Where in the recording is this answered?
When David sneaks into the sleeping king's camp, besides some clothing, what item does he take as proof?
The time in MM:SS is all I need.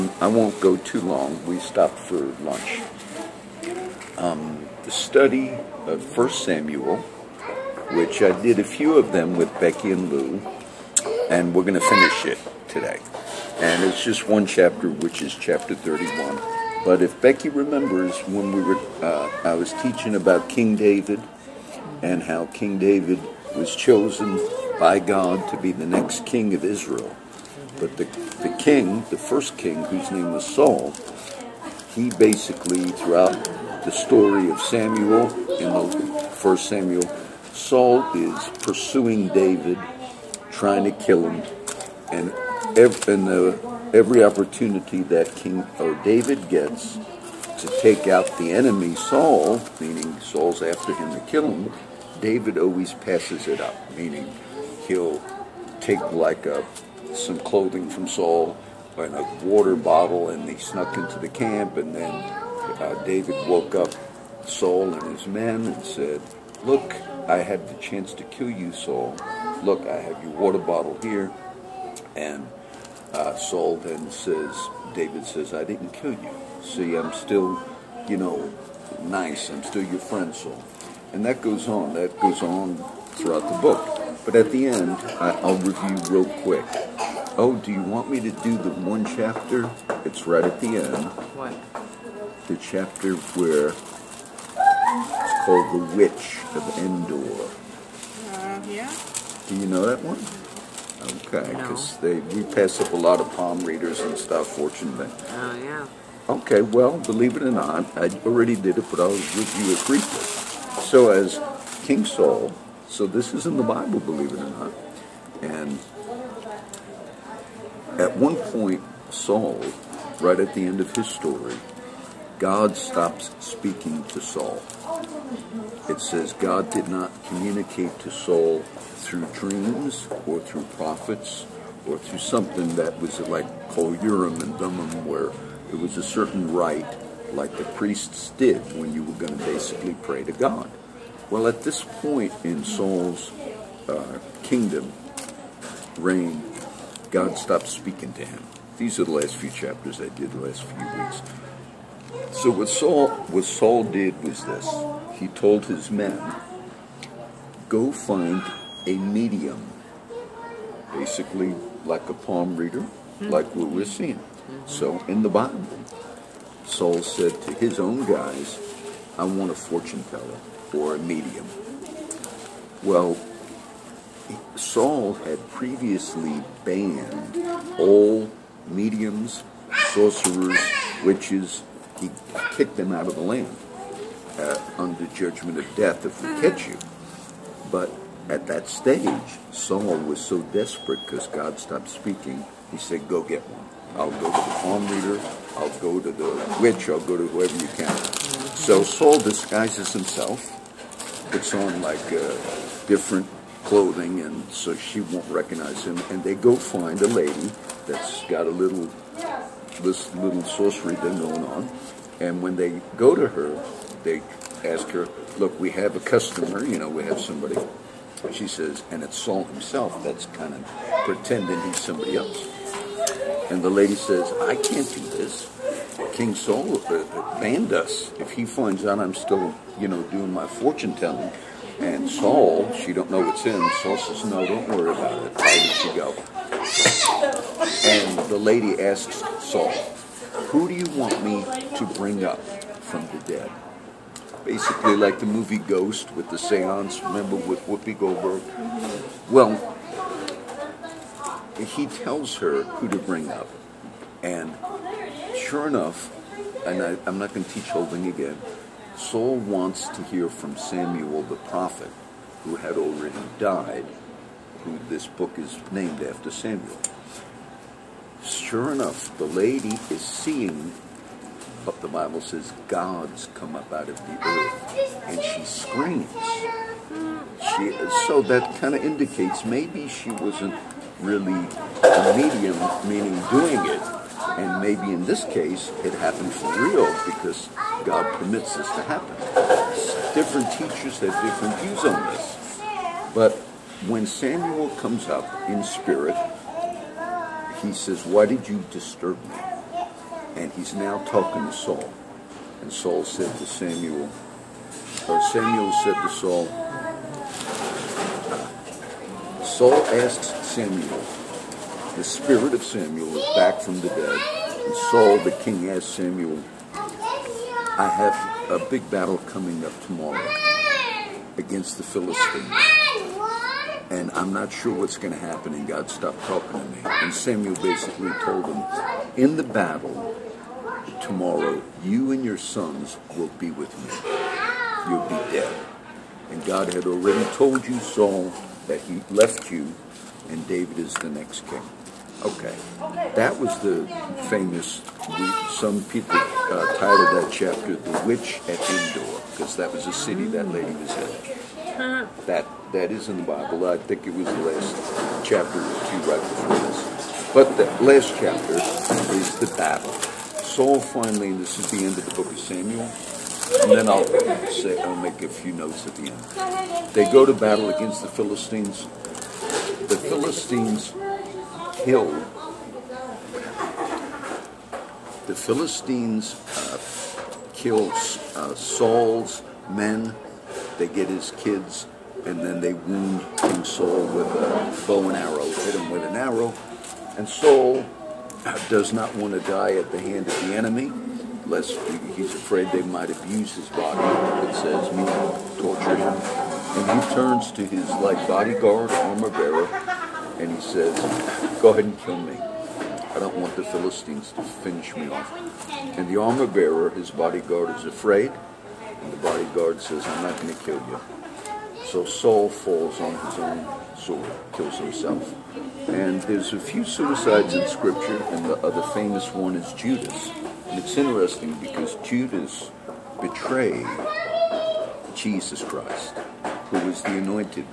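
00:59.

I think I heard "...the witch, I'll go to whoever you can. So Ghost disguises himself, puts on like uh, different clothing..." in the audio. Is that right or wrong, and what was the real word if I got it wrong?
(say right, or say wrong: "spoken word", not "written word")
wrong: "Saul", not "Ghost".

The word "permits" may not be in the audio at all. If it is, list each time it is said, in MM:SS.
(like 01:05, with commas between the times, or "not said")
04:48.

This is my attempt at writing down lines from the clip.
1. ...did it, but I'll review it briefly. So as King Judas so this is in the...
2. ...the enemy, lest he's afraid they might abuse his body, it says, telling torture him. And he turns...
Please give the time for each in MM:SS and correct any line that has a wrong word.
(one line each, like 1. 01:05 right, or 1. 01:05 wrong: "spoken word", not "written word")
1. 01:48 wrong: "Saul", not "Judas"
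2. 06:30 wrong: "meaning", not "telling".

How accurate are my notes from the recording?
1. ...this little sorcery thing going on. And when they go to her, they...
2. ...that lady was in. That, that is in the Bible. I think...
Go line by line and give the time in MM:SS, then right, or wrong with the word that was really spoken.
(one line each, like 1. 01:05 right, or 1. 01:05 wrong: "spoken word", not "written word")
1. 03:29 right
2. 05:50 right.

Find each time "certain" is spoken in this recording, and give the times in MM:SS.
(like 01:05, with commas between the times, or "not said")
02:16.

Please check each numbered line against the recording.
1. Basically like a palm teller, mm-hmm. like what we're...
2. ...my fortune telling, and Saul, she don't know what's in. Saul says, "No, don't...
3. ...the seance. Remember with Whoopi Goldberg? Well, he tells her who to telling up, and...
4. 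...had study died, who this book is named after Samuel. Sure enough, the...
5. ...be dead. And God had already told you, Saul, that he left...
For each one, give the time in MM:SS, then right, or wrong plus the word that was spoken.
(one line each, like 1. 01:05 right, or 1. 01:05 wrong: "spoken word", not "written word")
1. 02:40 wrong: "reader", not "teller"
2. 03:50 right
3. 04:06 wrong: "bring", not "telling"
4. 04:22 wrong: "already", not "study"
5. 05:35 right.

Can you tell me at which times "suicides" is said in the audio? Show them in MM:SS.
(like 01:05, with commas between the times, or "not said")
06:56.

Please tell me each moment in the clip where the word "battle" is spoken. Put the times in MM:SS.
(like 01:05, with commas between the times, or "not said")
05:18, 05:29, 05:59, 06:07.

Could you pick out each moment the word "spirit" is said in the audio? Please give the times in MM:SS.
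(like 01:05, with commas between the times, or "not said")
04:55, 05:12.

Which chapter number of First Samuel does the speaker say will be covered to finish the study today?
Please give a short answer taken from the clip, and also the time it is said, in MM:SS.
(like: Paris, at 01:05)
31, at 00:15.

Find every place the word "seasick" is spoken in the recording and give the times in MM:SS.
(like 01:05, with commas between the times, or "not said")
not said.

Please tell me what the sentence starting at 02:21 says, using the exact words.
Well, at this point in Saul's uh, kingdom reign, God stopped speaking to him.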